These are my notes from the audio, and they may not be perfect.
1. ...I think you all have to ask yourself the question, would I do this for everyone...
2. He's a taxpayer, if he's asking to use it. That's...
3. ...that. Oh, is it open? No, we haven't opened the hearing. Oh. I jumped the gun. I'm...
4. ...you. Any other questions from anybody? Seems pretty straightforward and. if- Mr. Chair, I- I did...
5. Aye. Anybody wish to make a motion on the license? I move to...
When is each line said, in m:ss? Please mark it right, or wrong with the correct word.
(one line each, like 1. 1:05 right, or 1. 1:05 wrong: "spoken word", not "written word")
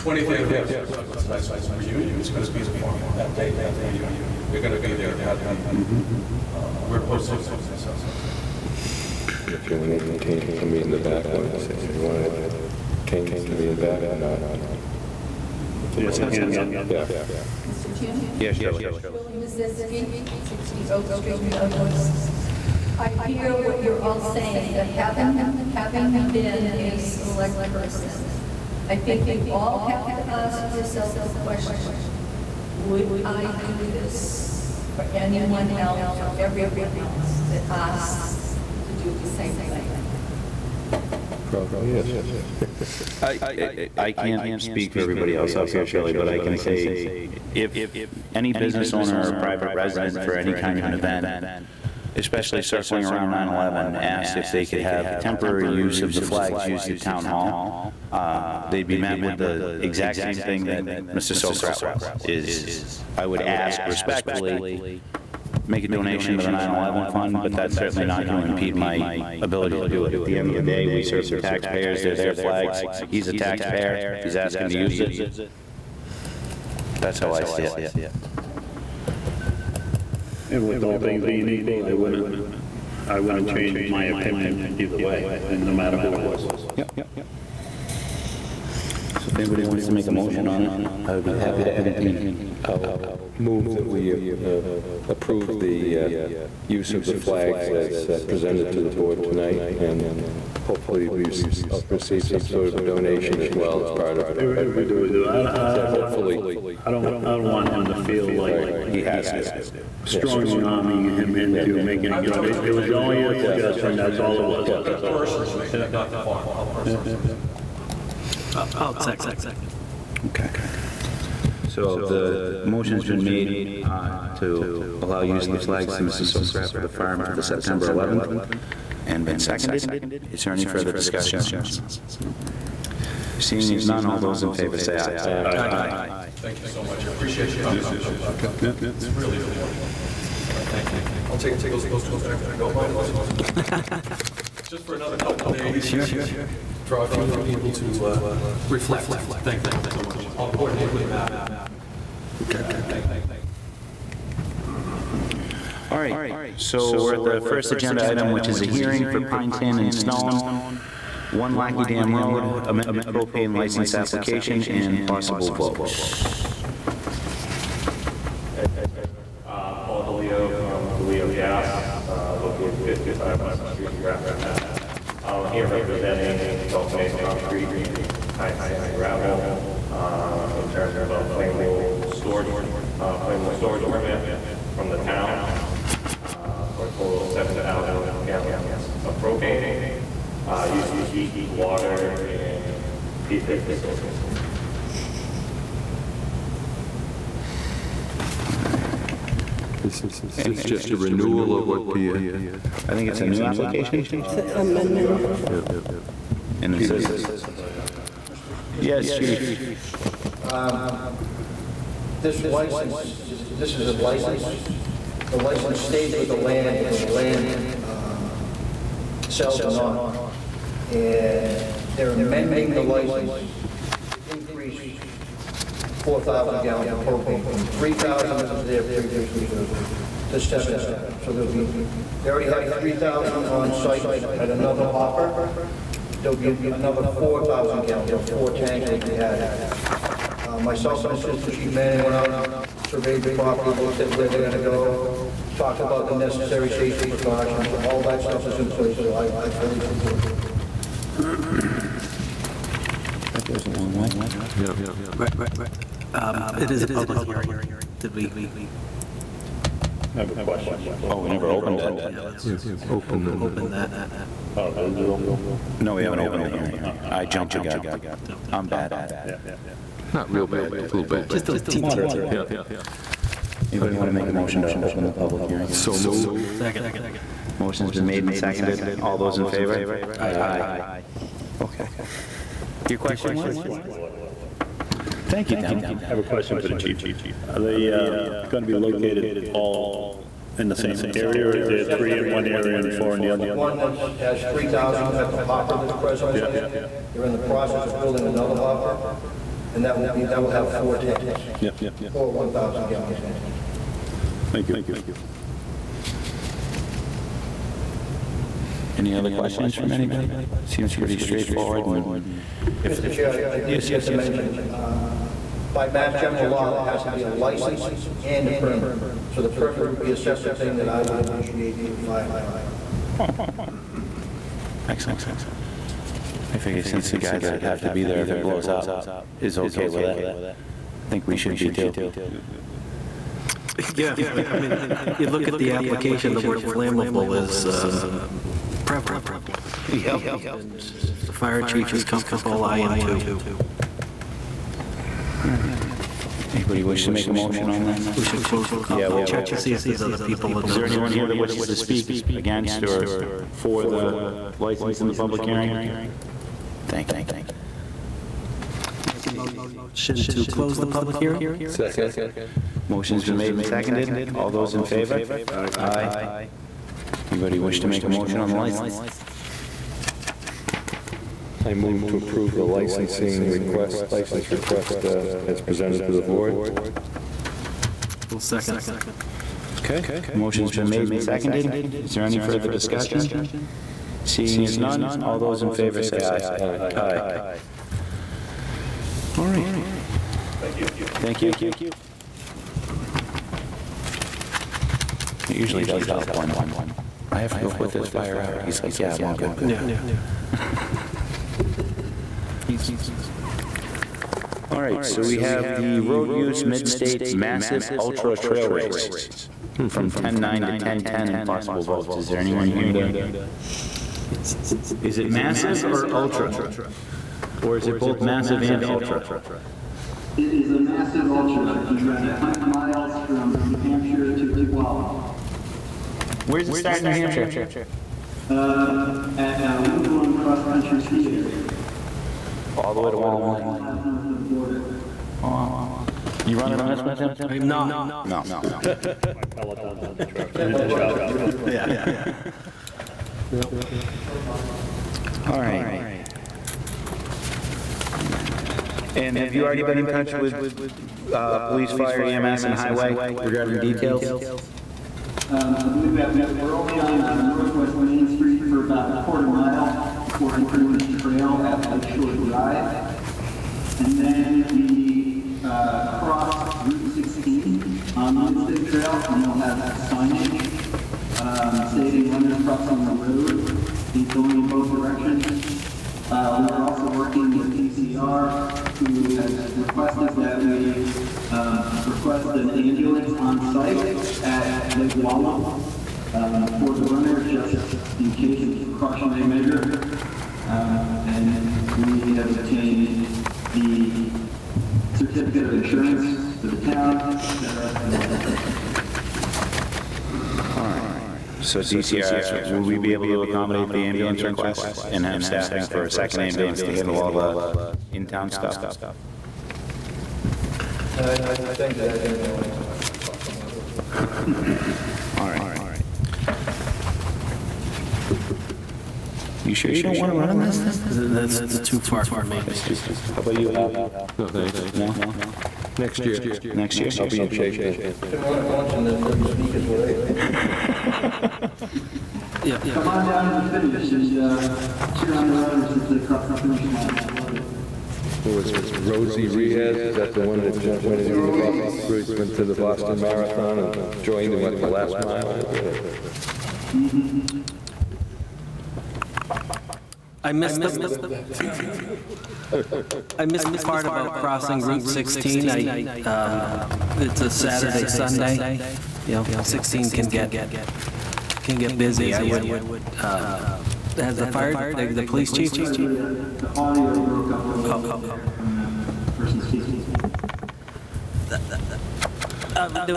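1. 0:28 wrong: "anyone", not "everyone"
2. 1:13 right
3. 4:23 right
4. 5:04 right
5. 6:05 right.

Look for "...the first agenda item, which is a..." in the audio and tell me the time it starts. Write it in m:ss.
2:37.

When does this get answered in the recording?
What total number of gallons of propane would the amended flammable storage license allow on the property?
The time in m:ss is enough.
3:07.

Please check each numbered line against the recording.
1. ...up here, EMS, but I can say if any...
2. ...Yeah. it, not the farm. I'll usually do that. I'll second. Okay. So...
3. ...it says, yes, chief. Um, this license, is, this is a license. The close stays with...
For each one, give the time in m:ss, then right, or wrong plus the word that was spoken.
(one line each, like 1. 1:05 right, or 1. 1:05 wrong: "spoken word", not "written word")
1. 0:45 wrong: "Shelley", not "EMS"
2. 1:55 wrong: "personally", not "usually"
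3. 3:26 wrong: "license", not "close".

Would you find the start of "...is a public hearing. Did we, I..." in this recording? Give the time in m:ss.
4:16.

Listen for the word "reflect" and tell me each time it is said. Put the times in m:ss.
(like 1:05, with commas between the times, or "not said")
2:28.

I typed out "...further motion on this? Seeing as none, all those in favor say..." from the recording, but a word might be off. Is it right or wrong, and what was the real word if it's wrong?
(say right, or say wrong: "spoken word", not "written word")
wrong: "discussion", not "motion".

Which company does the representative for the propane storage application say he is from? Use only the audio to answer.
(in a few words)
DeLeo Gas.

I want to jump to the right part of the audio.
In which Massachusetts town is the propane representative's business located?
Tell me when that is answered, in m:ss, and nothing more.
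2:53.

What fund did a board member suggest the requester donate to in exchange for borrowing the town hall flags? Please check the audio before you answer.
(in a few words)
9/11 fund.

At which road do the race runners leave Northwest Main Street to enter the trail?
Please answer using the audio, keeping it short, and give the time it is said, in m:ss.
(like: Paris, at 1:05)
Lakeshore Drive, at 7:41.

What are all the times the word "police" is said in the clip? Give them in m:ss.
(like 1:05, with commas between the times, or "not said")
7:31, 9:25.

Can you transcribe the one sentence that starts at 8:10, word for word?
Um, and we have obtained the certificate of insurance for the town, et cetera.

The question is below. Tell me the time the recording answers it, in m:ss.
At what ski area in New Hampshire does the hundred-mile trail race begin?
7:09.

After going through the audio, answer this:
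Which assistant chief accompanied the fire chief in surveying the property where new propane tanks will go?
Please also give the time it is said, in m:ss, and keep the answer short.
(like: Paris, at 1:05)
Manning, at 4:01.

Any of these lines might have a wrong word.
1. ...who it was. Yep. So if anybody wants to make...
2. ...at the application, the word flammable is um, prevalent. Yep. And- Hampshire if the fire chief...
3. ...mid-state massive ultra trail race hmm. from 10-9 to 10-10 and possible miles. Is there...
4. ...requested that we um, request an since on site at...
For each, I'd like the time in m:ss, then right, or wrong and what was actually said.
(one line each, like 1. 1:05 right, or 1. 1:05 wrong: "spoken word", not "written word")
1. 1:25 right
2. 5:35 wrong: "And", not "Hampshire"
3. 6:46 wrong: "votes", not "miles"
4. 7:59 wrong: "ambulance", not "since".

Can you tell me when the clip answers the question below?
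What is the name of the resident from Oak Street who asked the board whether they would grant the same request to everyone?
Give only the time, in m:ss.
0:19.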